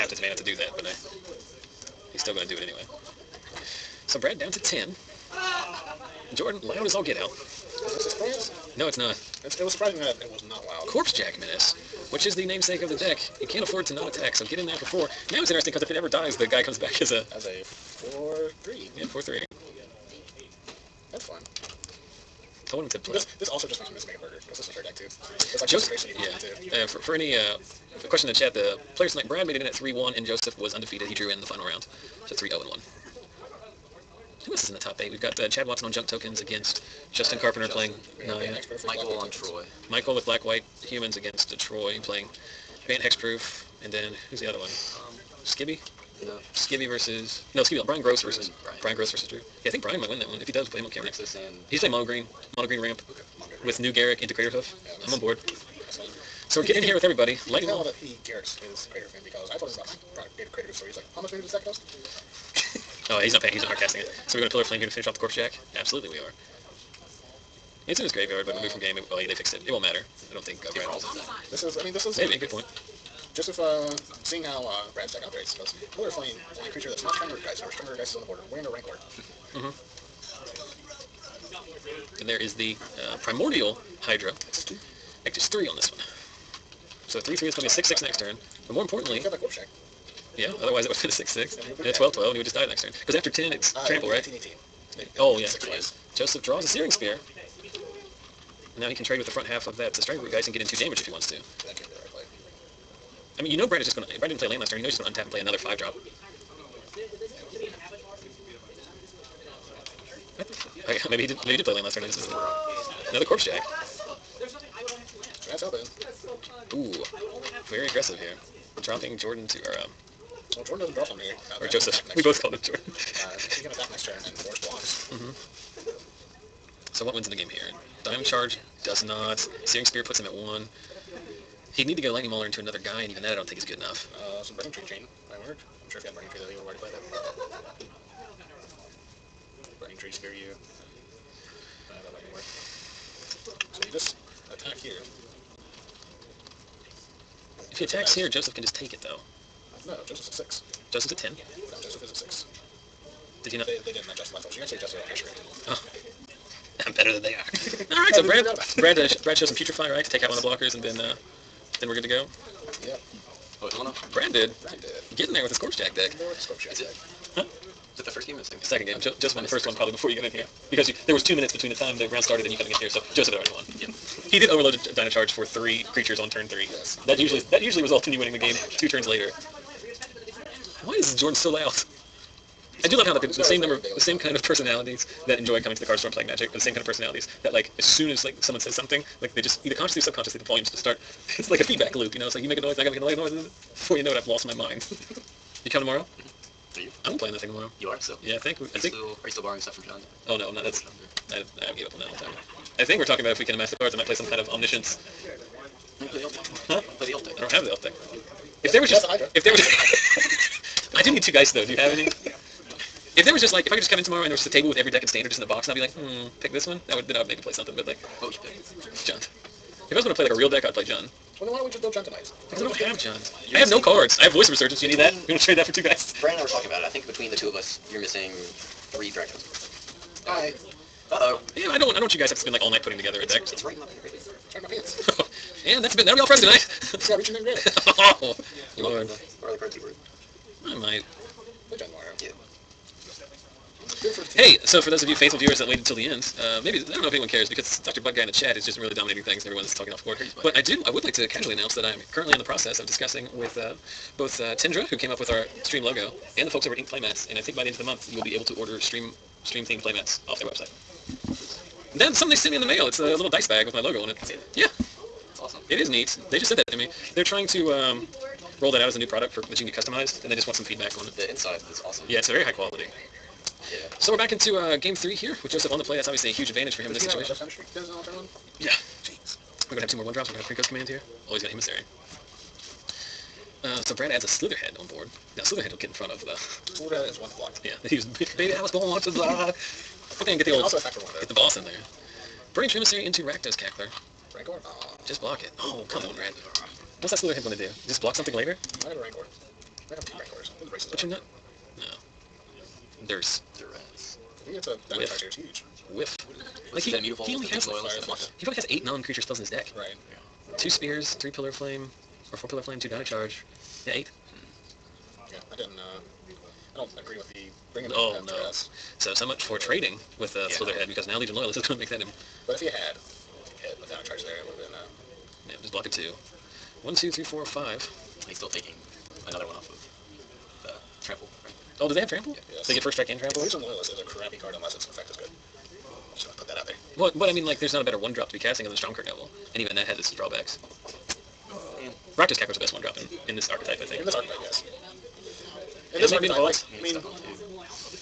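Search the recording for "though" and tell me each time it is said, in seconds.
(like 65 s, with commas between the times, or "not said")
136 s, 149 s, 211 s, 291 s.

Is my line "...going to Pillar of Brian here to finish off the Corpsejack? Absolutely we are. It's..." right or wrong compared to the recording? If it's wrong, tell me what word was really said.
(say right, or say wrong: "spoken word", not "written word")
wrong: "Flame", not "Brian".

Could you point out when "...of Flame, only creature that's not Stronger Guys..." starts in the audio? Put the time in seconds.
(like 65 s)
76 s.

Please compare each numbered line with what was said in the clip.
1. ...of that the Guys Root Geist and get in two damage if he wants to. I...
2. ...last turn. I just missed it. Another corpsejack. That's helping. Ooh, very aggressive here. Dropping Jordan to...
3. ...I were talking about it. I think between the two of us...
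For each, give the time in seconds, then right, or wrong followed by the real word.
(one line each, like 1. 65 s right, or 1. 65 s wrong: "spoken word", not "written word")
1. 99 s wrong: "Striker", not "Guys"
2. 111 s right
3. 226 s right.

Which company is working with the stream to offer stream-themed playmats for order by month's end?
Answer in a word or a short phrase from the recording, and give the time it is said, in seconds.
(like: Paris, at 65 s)
Inked Playmats, at 256 s.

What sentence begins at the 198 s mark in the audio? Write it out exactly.
Still, are you still borrowing stuff from John?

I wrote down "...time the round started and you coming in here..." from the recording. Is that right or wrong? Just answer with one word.
right.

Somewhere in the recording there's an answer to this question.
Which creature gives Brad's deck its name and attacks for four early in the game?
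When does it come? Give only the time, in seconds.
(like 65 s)
10 s.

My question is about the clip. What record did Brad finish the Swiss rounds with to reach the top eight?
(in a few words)
3-1.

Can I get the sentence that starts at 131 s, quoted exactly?
He'd need to go Lightning Mauler into another guy, and even that I don't think is good enough.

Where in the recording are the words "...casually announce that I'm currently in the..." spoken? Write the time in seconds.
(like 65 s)
251 s.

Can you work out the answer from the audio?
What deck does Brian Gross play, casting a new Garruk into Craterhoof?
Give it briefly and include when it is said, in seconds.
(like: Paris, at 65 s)
mono green ramp, at 52 s.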